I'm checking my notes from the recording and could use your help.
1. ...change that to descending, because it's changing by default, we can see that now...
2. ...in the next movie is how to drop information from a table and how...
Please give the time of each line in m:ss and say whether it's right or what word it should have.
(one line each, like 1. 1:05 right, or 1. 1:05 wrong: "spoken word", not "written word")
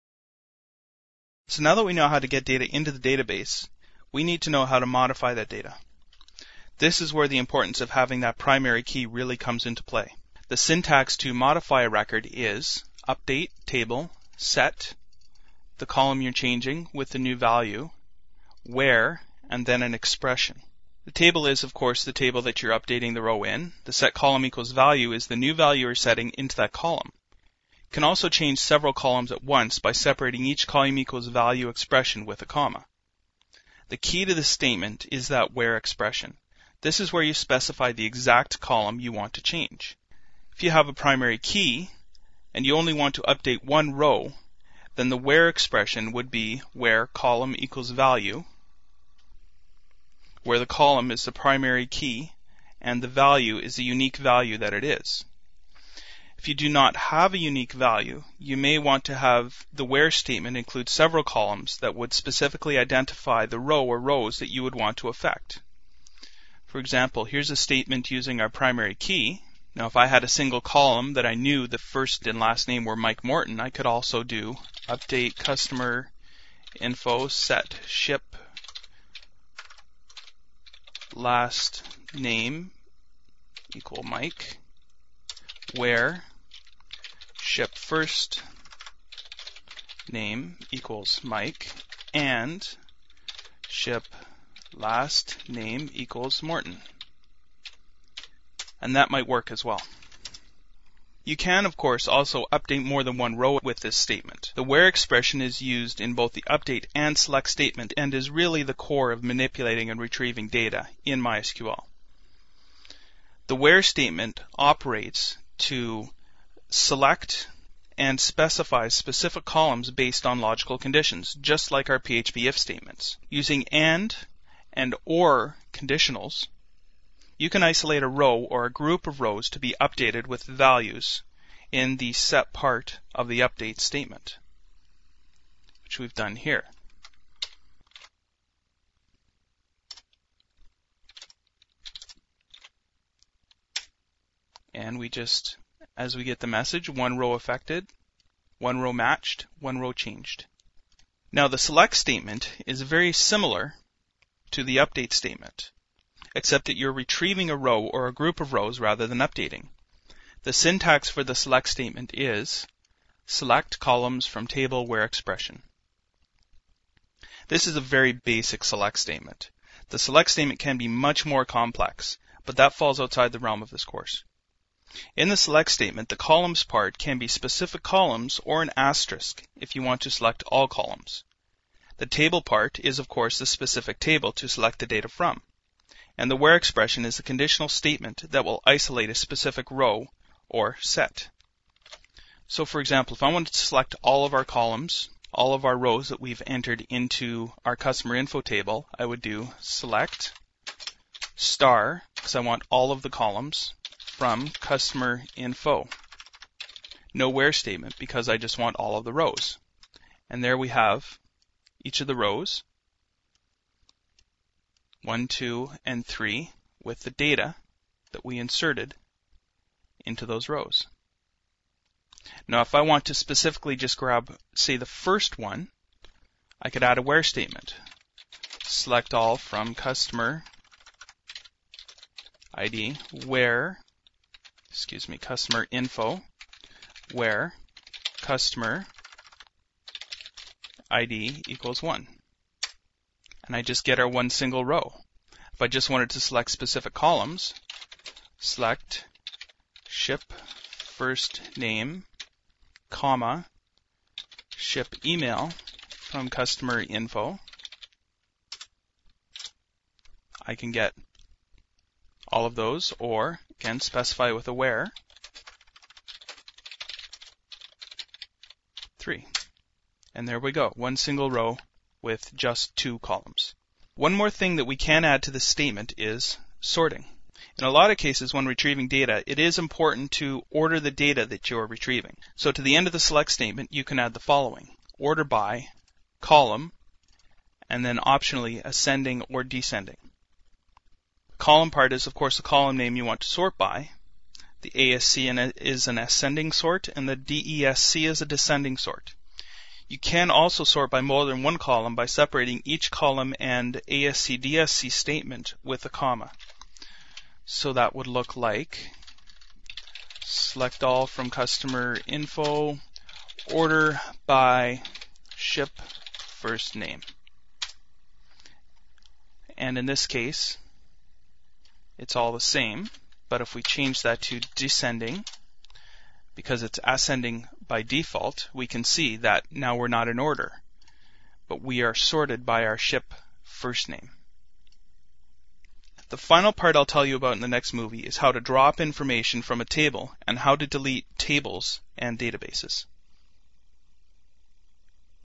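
1. 5:23 wrong: "ascending", not "changing"
2. 5:37 right.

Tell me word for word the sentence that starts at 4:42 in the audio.
So to the end of the select statement, you can add the following.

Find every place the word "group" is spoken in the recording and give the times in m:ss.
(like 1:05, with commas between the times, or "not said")
2:08, 2:38.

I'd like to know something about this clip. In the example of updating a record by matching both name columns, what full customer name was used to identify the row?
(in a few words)
Mike Morton.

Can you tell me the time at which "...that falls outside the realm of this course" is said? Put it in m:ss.
2:52.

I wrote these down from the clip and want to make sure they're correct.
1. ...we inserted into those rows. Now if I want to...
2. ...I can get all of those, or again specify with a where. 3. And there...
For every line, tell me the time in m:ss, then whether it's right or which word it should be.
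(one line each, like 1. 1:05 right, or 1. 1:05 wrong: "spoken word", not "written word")
1. 3:38 right
2. 4:20 right.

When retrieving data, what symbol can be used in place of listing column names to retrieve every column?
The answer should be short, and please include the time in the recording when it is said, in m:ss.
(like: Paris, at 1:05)
asterisk, at 2:58.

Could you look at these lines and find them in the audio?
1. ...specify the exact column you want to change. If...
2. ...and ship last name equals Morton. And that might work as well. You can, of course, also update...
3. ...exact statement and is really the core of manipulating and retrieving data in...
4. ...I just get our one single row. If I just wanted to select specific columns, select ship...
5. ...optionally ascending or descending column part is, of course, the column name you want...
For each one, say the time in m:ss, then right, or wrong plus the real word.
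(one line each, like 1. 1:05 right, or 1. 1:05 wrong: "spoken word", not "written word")
1. 0:37 right
2. 1:32 right
3. 1:47 wrong: "select", not "exact"
4. 4:03 right
5. 4:47 right.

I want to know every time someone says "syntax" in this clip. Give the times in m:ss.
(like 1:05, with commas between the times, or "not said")
0:10, 2:40.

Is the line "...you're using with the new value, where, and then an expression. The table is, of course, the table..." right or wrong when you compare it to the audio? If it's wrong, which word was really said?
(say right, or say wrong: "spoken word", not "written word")
wrong: "changing", not "using".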